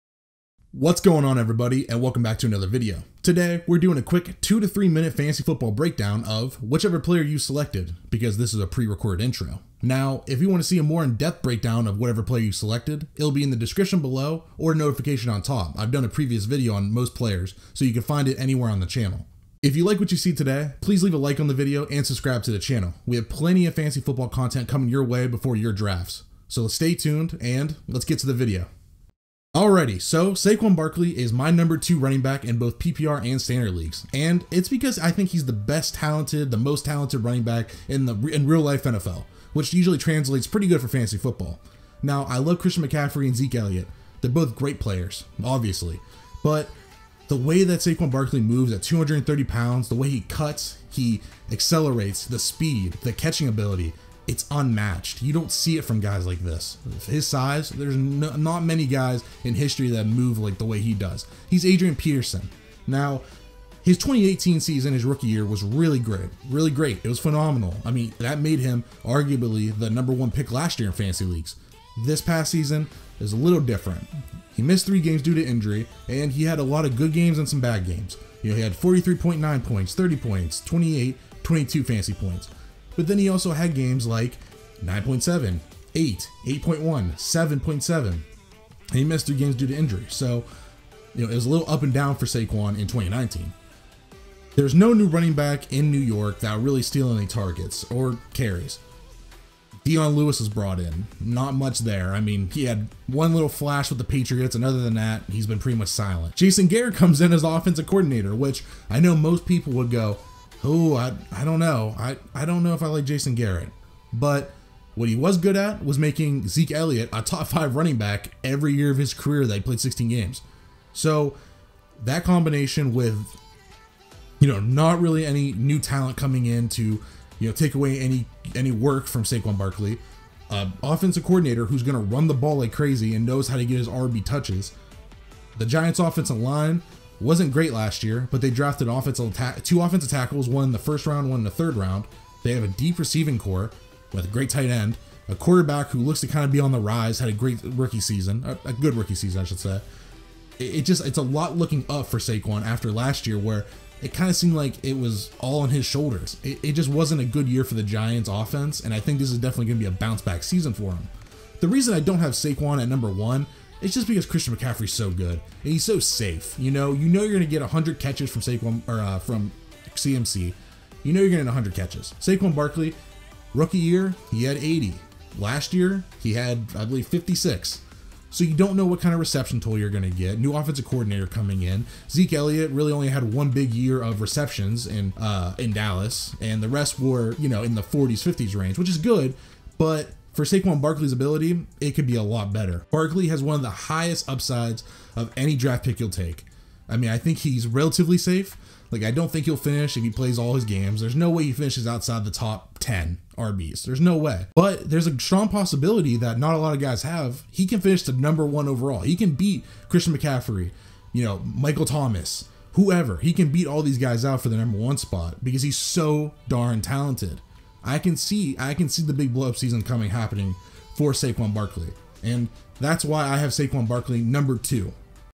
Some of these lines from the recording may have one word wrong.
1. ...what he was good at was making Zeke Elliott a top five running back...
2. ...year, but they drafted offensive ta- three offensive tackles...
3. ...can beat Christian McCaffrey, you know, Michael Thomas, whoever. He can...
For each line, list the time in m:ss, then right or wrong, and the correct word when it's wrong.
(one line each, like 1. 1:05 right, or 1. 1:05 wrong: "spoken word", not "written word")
1. 1:54 right
2. 2:18 wrong: "two", not "three"
3. 3:29 right.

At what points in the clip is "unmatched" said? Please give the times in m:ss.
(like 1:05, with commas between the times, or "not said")
0:54.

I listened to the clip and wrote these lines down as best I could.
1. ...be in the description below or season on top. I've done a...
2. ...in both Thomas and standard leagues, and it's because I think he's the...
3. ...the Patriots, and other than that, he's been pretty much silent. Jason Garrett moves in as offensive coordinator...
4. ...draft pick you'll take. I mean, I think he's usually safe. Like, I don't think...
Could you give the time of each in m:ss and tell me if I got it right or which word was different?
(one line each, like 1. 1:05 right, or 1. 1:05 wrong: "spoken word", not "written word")
1. 0:13 wrong: "notification", not "season"
2. 0:32 wrong: "PPR", not "Thomas"
3. 1:43 wrong: "comes", not "moves"
4. 3:15 wrong: "relatively", not "usually".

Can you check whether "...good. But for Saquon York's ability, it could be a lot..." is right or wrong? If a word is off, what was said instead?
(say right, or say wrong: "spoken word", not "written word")
wrong: "Barkley", not "York".